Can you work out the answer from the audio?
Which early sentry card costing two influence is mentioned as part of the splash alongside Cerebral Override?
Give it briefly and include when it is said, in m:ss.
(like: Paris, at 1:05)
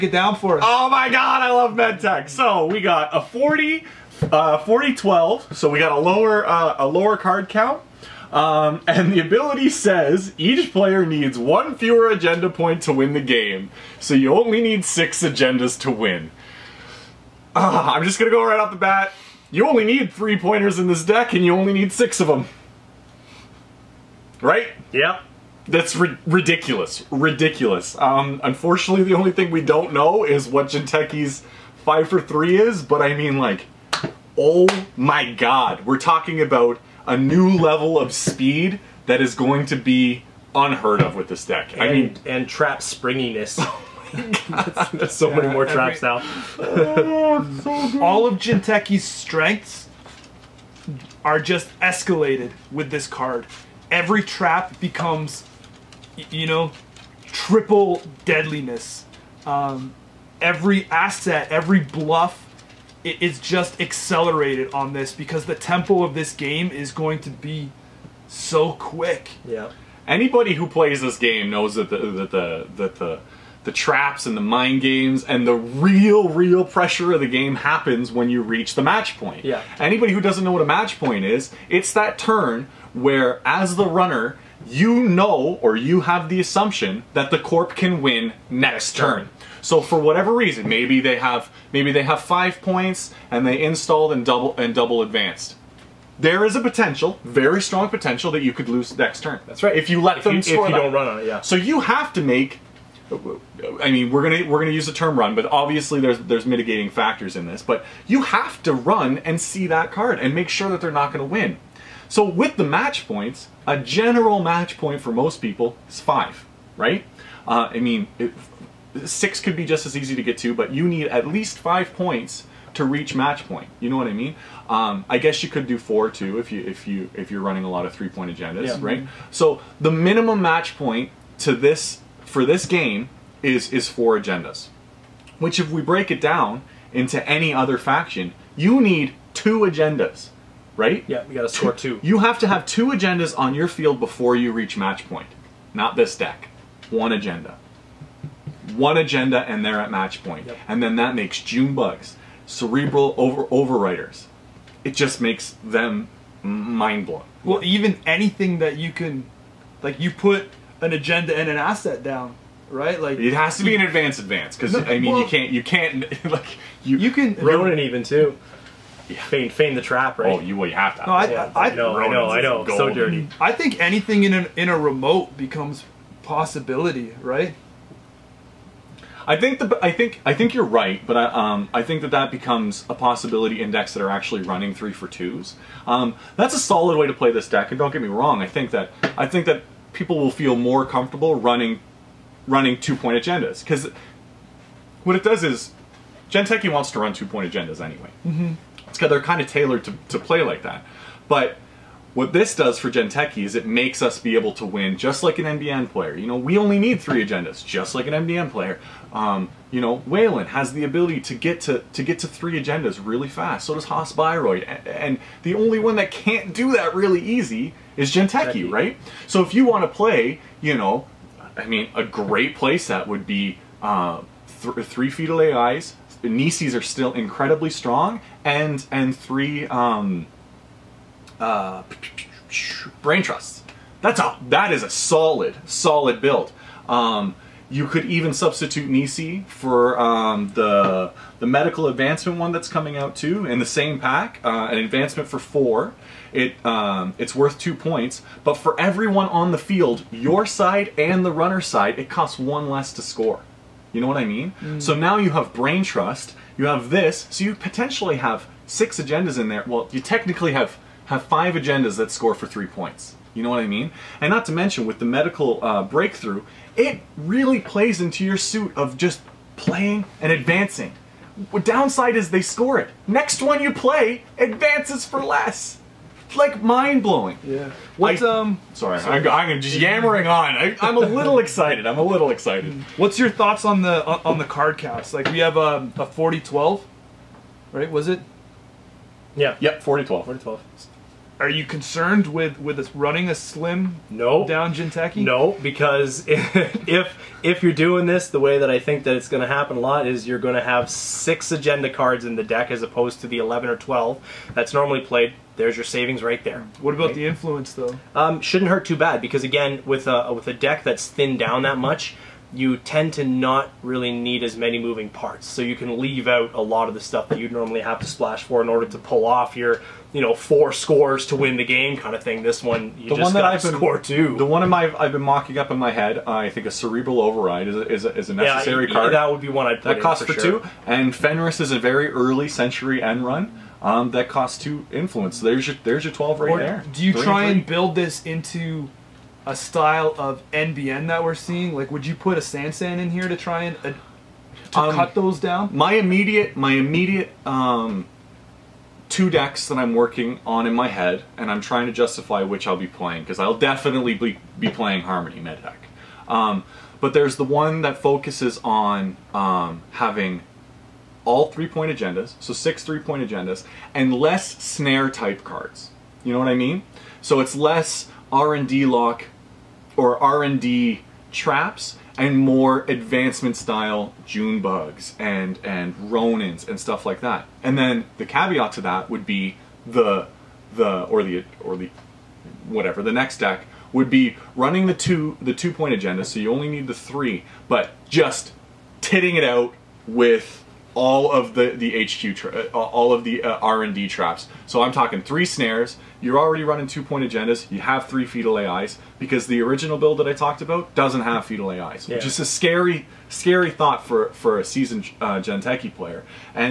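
Fenris, at 5:31.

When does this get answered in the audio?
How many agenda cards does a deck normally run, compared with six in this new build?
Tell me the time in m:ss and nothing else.
5:03.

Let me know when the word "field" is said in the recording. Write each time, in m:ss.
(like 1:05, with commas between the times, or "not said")
2:23, 4:09.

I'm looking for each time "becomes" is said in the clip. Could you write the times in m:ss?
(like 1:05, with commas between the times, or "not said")
0:54, 2:55, 3:02.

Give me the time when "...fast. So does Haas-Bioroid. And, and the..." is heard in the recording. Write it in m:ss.
3:33.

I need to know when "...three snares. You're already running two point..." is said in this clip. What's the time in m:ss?
6:35.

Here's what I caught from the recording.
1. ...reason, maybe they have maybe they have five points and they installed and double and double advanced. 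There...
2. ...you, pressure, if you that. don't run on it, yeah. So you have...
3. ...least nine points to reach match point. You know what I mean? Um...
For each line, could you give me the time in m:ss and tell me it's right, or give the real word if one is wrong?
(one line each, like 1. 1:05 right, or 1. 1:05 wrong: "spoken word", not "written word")
1. 1:30 right
2. 1:40 wrong: "score", not "pressure"
3. 2:01 wrong: "five", not "nine".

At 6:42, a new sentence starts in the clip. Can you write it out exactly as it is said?
which is a scary scary thought for for a seasoned uh, Jinteki player.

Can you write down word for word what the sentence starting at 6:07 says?
So it's less R&D lock or R&D traps and more advancement style June bugs and and Ronins and stuff like that.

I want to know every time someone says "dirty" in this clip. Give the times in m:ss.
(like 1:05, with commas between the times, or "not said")
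2:52.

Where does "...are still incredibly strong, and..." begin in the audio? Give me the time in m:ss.
3:46.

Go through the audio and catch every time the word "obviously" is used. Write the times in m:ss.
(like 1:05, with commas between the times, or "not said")
1:45.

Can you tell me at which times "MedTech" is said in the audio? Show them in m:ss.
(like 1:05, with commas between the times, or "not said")
0:01, 5:55.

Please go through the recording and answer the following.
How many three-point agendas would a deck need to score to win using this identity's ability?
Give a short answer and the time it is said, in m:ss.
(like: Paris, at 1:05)
6, at 0:21.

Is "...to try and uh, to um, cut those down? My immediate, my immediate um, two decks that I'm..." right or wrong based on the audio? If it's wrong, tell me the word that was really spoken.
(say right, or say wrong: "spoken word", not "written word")
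right.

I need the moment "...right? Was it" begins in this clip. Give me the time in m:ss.
4:47.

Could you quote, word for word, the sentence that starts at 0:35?
We're talking about a new level of speed that is going to be unheard of with this deck.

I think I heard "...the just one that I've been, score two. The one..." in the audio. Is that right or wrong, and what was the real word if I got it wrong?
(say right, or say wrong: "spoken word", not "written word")
right.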